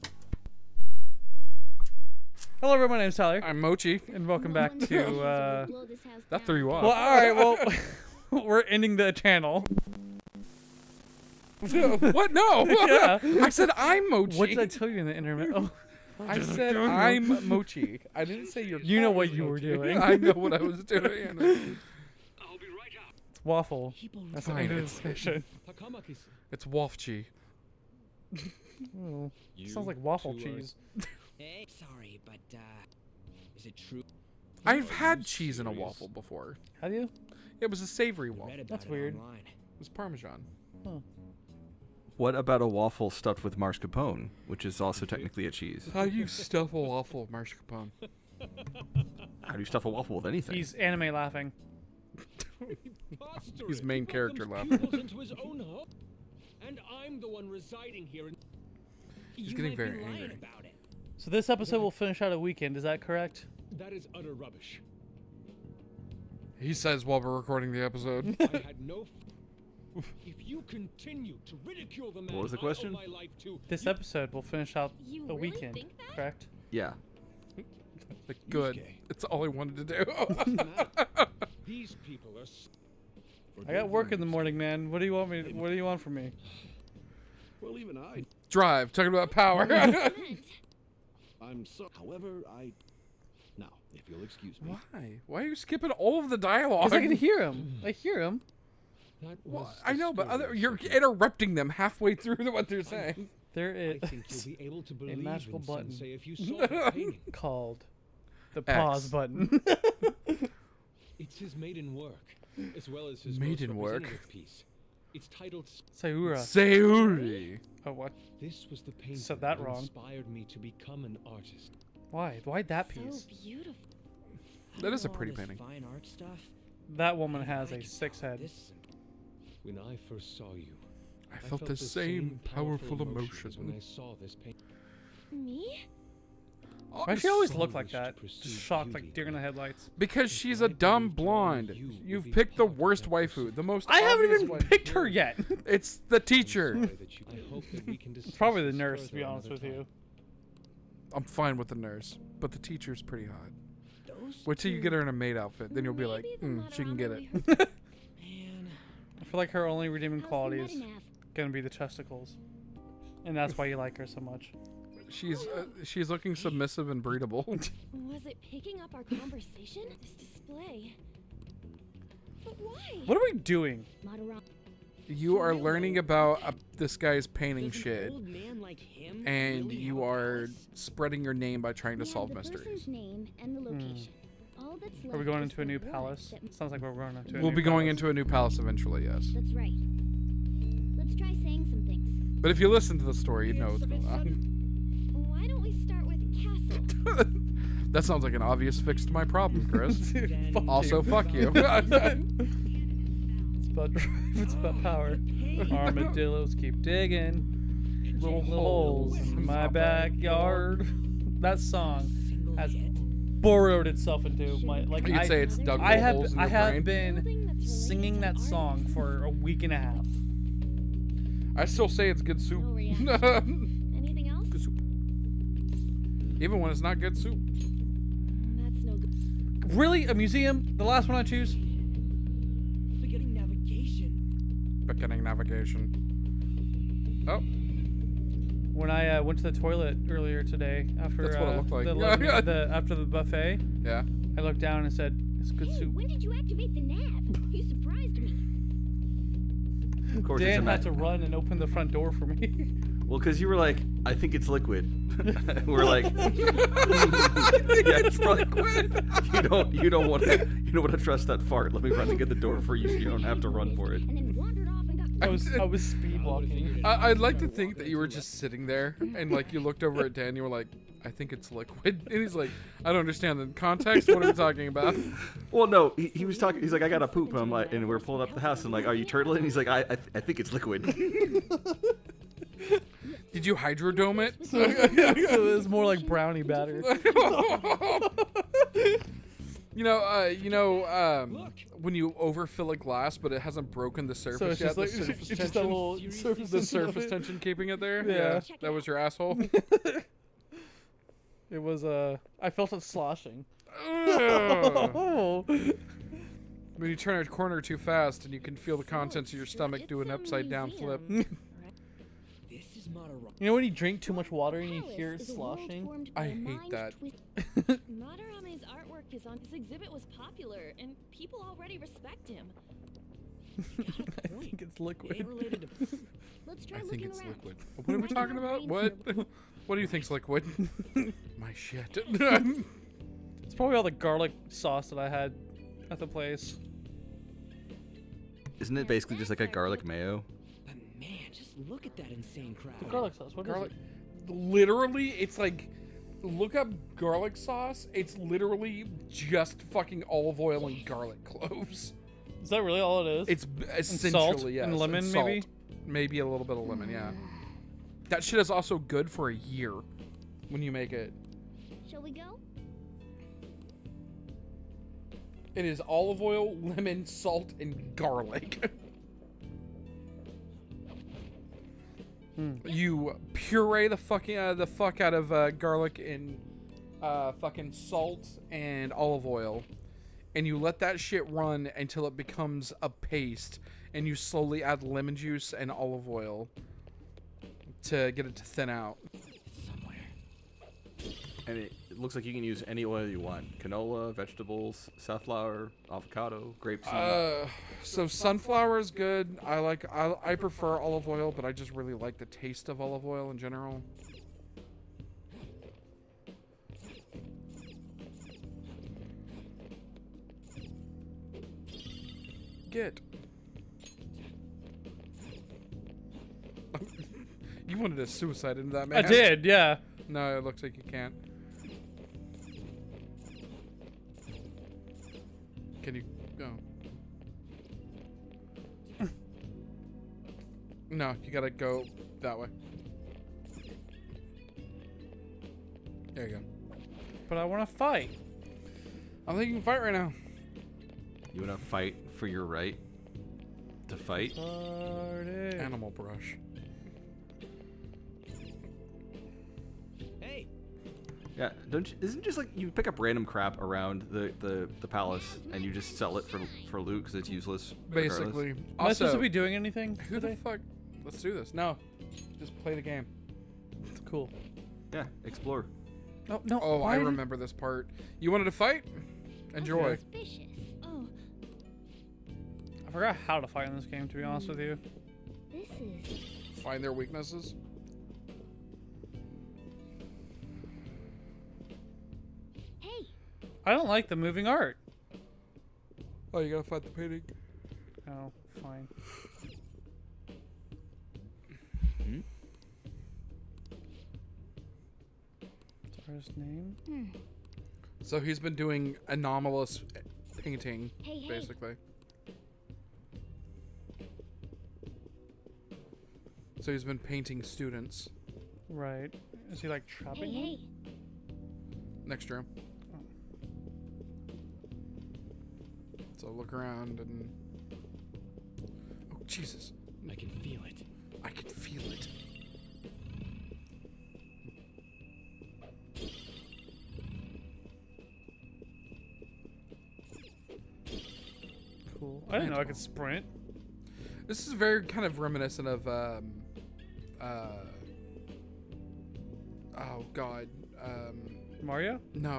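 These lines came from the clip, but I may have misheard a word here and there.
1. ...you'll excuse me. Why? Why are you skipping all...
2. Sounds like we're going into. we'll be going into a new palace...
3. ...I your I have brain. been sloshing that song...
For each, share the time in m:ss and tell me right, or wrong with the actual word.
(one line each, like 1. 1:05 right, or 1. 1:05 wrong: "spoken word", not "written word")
1. 1:34 right
2. 3:06 right
3. 3:36 wrong: "singing", not "sloshing".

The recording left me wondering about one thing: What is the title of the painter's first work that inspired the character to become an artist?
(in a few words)
Sayuri.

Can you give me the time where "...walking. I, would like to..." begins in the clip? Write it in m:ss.
4:26.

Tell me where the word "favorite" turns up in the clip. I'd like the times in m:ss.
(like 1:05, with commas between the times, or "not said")
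not said.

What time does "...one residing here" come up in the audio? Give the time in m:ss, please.
0:57.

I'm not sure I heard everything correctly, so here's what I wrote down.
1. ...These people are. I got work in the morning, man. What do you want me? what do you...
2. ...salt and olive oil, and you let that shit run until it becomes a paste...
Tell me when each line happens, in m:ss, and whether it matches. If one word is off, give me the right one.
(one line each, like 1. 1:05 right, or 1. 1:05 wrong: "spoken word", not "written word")
1. 1:21 right
2. 6:17 right.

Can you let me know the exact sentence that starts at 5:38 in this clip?
Isn't it basically just like a garlic mayo?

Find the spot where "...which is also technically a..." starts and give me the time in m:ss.
0:44.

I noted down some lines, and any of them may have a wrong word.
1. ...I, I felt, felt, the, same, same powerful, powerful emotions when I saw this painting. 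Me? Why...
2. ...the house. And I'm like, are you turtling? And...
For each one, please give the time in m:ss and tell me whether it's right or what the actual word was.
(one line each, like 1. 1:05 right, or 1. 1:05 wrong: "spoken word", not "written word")
1. 2:11 right
2. 4:38 right.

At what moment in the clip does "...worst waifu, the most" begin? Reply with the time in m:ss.
2:22.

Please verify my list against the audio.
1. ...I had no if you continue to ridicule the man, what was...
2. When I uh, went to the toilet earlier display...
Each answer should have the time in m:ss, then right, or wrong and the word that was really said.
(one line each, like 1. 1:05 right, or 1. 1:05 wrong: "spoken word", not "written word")
1. 1:08 right
2. 3:58 wrong: "today", not "display".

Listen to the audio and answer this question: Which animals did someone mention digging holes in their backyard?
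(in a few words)
Armadillos.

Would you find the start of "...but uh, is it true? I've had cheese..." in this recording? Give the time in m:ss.
0:32.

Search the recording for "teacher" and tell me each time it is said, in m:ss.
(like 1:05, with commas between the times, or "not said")
2:26, 2:32.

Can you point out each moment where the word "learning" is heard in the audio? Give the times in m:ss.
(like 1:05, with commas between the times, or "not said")
2:55.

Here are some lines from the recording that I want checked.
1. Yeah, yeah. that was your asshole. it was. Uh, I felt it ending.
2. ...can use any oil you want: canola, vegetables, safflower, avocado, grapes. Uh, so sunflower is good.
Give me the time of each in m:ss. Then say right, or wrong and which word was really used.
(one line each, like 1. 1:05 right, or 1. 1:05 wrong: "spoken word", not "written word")
1. 4:58 wrong: "sloshing", not "ending"
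2. 6:32 right.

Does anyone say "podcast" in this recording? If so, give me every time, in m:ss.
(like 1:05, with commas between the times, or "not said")
not said.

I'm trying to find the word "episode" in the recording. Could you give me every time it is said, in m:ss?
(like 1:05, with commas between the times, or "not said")
1:01, 1:07, 1:13.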